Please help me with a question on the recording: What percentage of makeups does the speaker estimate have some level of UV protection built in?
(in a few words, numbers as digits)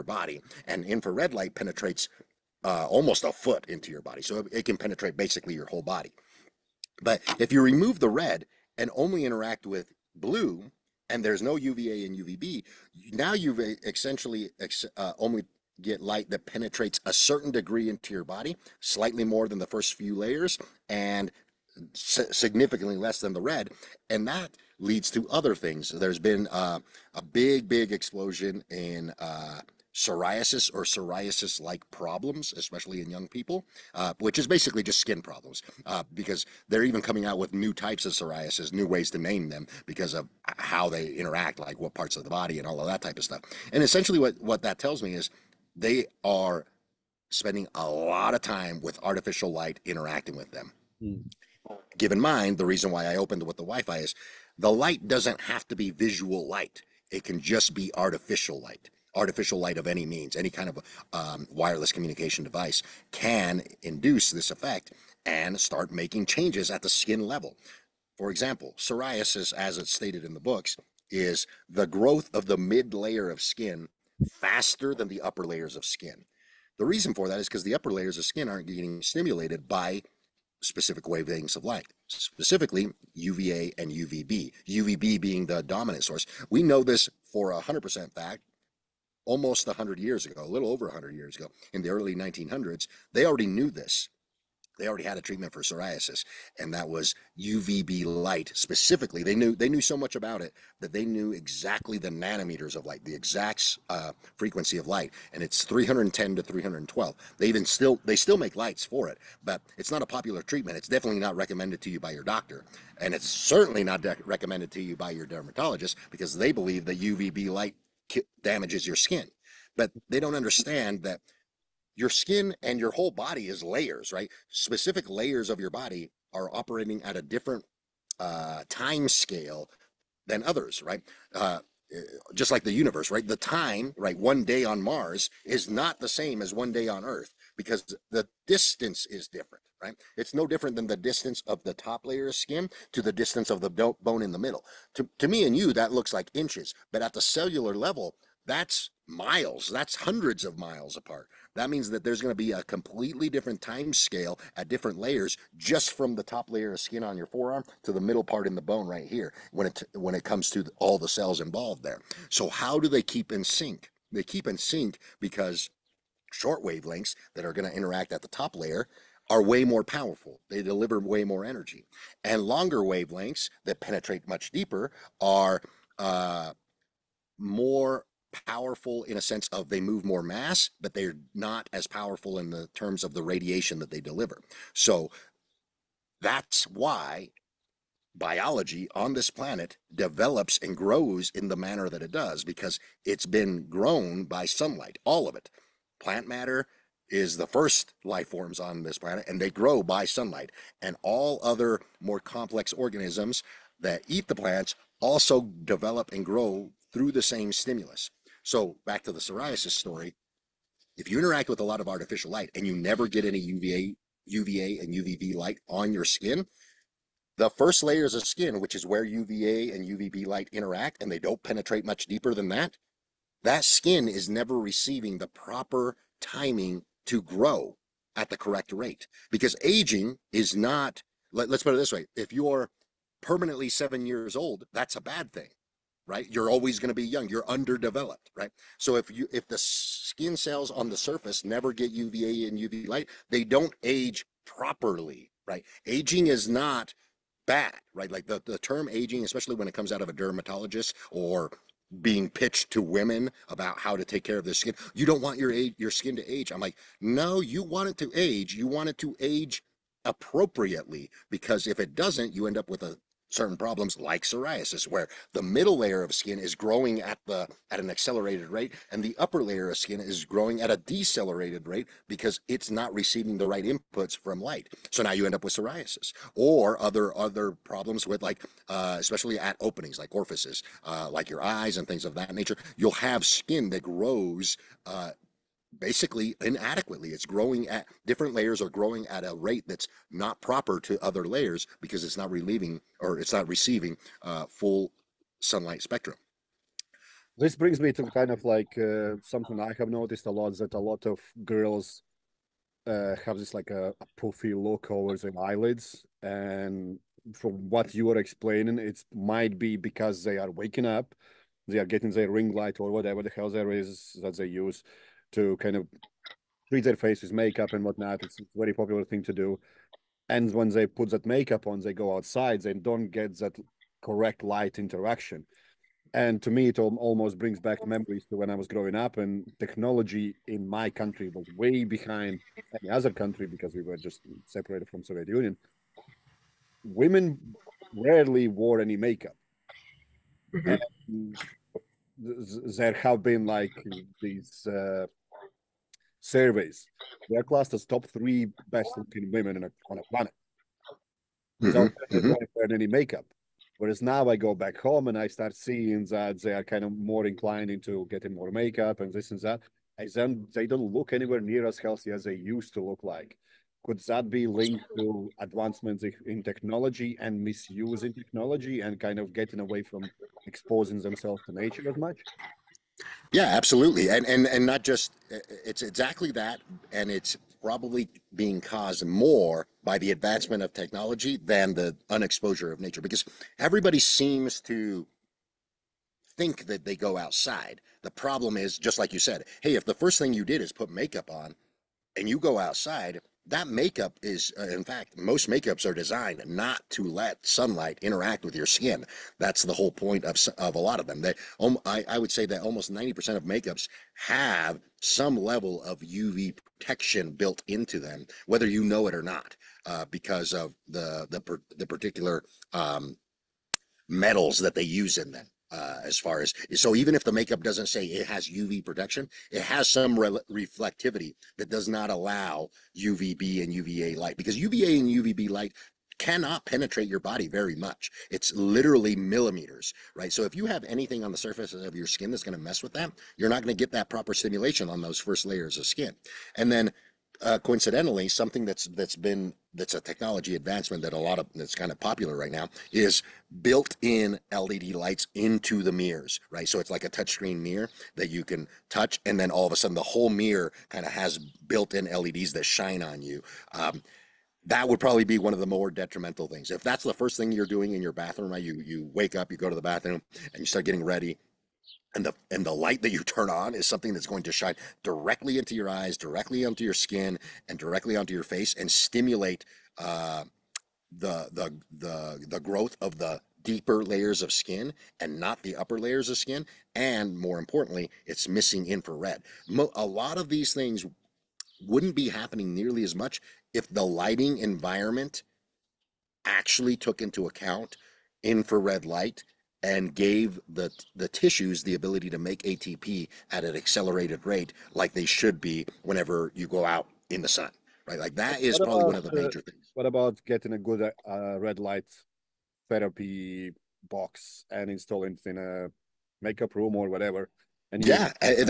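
90%.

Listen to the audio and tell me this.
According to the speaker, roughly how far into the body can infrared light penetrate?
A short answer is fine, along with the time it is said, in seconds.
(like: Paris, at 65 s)
almost a foot, at 2 s.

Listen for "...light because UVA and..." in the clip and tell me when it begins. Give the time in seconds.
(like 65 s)
424 s.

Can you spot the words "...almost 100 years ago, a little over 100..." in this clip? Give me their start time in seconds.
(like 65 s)
89 s.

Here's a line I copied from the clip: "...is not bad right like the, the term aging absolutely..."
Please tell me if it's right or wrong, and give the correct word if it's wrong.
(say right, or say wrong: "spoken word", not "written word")
wrong: "especially", not "absolutely".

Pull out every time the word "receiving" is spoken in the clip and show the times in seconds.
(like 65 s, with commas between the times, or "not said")
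224 s, 272 s, 293 s.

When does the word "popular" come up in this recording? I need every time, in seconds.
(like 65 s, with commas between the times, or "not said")
110 s, 318 s, 441 s.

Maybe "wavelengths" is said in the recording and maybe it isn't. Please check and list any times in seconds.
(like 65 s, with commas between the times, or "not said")
81 s, 166 s, 172 s.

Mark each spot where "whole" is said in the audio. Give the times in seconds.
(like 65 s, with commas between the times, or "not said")
5 s, 122 s, 399 s, 450 s.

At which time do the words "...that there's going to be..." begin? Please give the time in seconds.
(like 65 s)
151 s.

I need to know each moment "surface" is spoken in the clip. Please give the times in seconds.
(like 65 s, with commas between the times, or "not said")
240 s, 431 s.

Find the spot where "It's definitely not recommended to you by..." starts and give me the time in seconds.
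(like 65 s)
110 s.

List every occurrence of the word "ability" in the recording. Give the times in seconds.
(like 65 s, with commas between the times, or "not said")
491 s.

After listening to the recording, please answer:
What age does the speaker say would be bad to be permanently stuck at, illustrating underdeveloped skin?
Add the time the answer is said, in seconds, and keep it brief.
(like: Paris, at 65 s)
7, at 233 s.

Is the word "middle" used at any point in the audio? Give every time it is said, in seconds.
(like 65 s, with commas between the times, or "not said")
144 s, 157 s, 265 s.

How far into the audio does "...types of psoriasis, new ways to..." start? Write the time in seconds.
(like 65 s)
37 s.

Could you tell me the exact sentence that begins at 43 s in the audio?
And essentially, what, what that tells me is they are spending a lot of time with artificial light interacting with them.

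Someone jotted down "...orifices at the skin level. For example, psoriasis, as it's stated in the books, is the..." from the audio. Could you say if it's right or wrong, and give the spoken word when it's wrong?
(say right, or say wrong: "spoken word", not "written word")
wrong: "changes", not "orifices".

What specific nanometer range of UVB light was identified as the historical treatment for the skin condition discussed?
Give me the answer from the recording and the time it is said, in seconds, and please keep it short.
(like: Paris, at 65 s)
310 to 312, at 105 s.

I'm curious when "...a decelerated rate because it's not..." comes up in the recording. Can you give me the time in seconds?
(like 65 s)
270 s.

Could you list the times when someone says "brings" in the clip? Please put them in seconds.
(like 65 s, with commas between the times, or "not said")
297 s, 327 s.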